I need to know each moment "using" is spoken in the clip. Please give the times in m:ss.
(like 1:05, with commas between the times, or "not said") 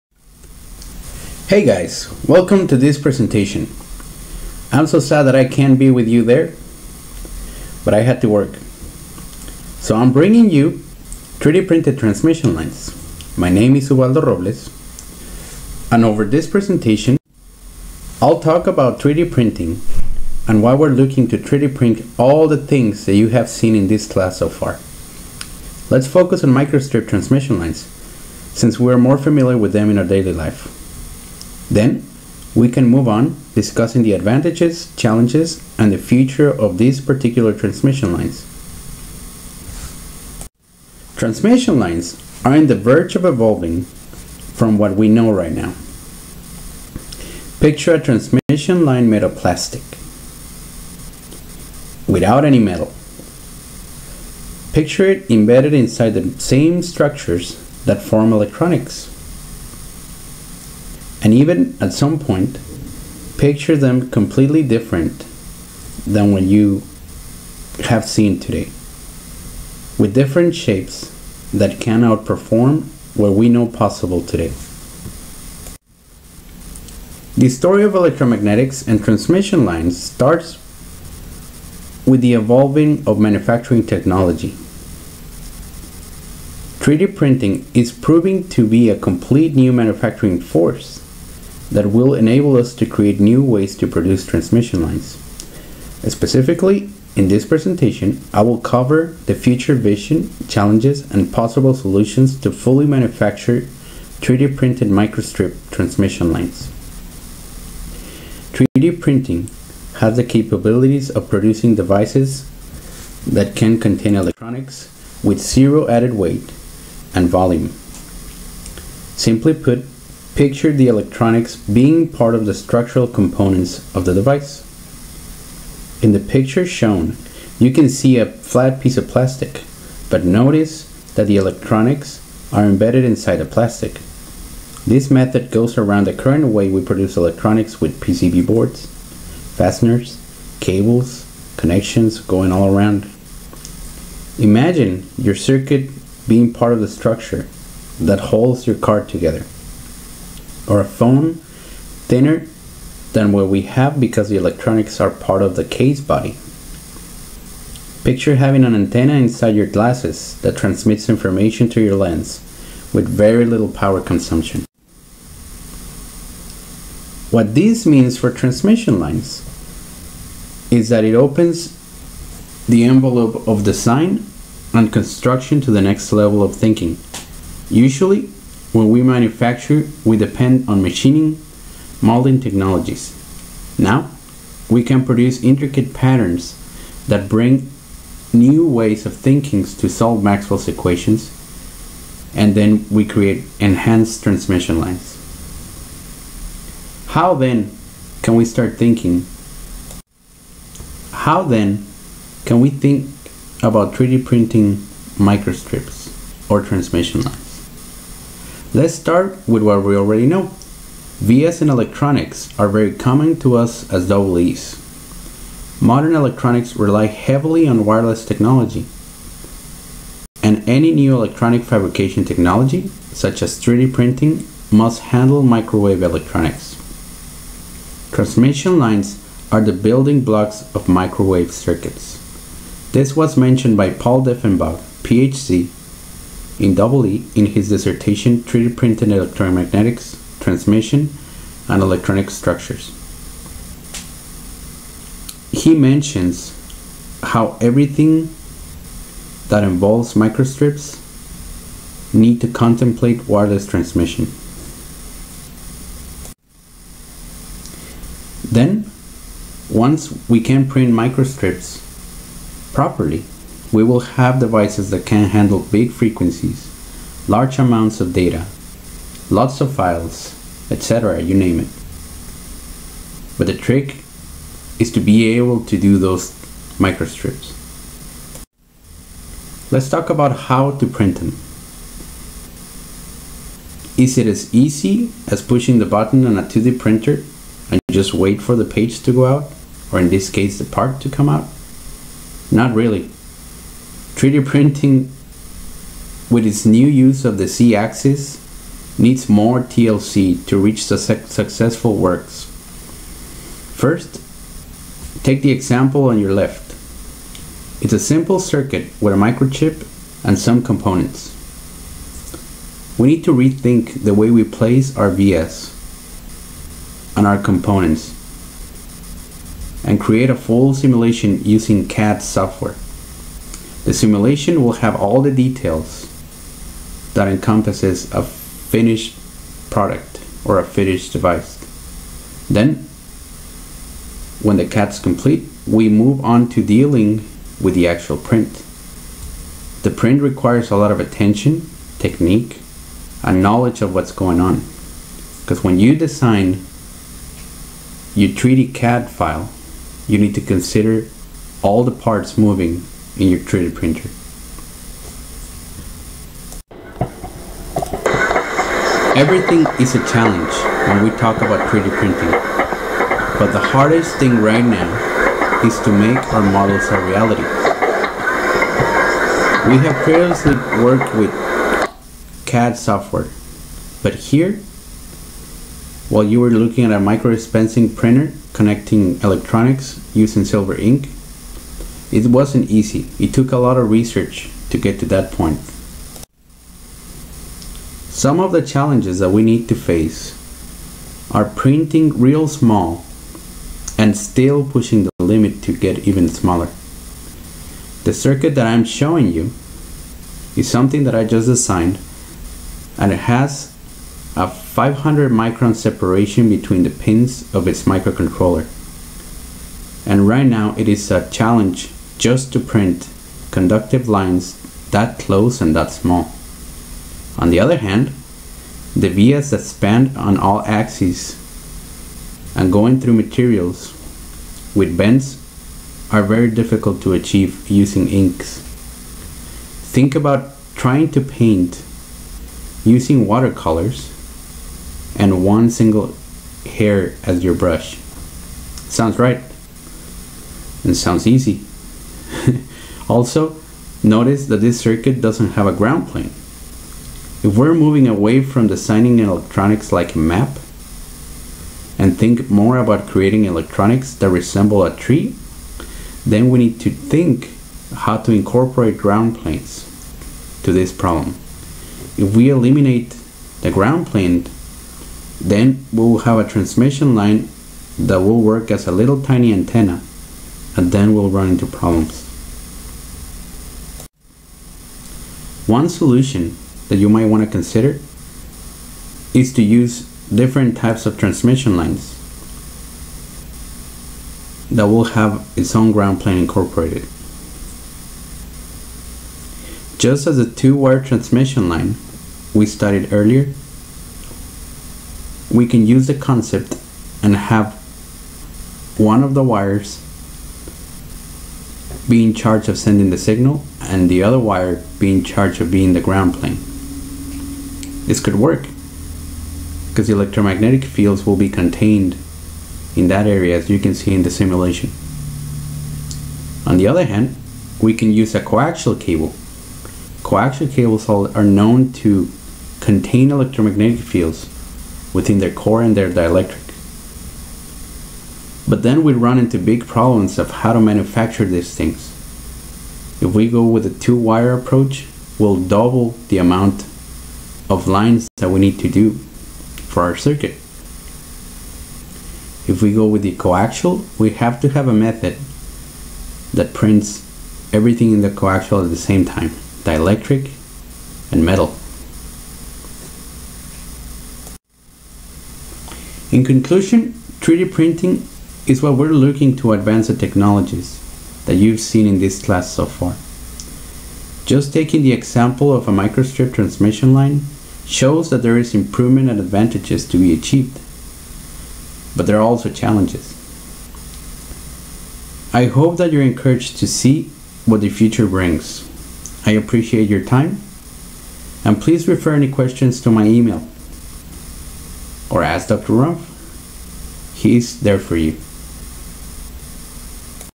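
5:21, 6:20, 7:07, 7:12.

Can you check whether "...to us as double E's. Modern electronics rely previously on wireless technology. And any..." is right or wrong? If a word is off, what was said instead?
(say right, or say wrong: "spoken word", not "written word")
wrong: "heavily", not "previously".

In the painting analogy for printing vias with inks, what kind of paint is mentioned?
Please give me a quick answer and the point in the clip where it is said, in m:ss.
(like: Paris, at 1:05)
Watercolors, at 7:13.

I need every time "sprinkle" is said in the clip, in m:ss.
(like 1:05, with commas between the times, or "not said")
not said.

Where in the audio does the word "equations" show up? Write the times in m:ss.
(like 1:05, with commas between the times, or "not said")
3:10.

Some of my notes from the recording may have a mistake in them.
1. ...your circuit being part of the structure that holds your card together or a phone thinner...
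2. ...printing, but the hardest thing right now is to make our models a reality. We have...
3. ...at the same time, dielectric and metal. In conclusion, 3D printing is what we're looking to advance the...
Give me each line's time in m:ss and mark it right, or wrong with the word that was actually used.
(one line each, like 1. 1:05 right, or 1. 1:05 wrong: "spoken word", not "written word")
1. 2:25 right
2. 6:01 right
3. 9:08 right.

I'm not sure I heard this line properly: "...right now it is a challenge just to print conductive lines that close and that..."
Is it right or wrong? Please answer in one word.
right.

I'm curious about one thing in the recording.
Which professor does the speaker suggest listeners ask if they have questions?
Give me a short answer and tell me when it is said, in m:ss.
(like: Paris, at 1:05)
Dr. Rumpf, at 9:45.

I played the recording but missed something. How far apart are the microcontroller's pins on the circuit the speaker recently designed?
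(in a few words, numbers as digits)
500 microns.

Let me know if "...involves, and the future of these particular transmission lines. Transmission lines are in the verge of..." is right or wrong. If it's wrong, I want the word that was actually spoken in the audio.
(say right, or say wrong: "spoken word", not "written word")
wrong: "challenges", not "involves".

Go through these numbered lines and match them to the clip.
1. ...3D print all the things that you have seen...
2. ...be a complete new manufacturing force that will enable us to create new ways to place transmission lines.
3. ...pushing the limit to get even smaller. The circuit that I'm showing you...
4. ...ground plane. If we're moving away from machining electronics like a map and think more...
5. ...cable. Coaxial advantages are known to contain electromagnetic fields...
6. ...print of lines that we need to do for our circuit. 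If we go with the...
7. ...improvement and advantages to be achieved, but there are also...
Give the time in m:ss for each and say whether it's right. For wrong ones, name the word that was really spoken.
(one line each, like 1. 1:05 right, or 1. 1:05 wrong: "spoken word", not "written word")
1. 0:21 right
2. 1:28 wrong: "produce", not "place"
3. 6:34 right
4. 7:25 wrong: "designing", not "machining"
5. 8:38 wrong: "cables", not "advantages"
6. 8:56 wrong: "amount", not "print"
7. 9:28 right.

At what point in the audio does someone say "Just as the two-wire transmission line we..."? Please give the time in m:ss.
8:09.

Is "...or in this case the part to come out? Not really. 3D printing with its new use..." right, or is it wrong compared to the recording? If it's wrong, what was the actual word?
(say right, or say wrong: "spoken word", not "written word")
right.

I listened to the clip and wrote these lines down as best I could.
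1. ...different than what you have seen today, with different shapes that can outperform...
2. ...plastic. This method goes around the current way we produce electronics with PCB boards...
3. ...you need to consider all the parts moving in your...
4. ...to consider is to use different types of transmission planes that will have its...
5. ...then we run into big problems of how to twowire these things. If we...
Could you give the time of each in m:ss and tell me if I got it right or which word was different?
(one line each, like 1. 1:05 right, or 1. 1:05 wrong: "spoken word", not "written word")
1. 1:04 right
2. 2:13 right
3. 5:50 right
4. 7:57 wrong: "lines", not "planes"
5. 8:48 wrong: "manufacture", not "twowire".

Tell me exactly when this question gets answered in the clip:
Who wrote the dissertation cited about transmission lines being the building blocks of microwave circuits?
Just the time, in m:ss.
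3:53.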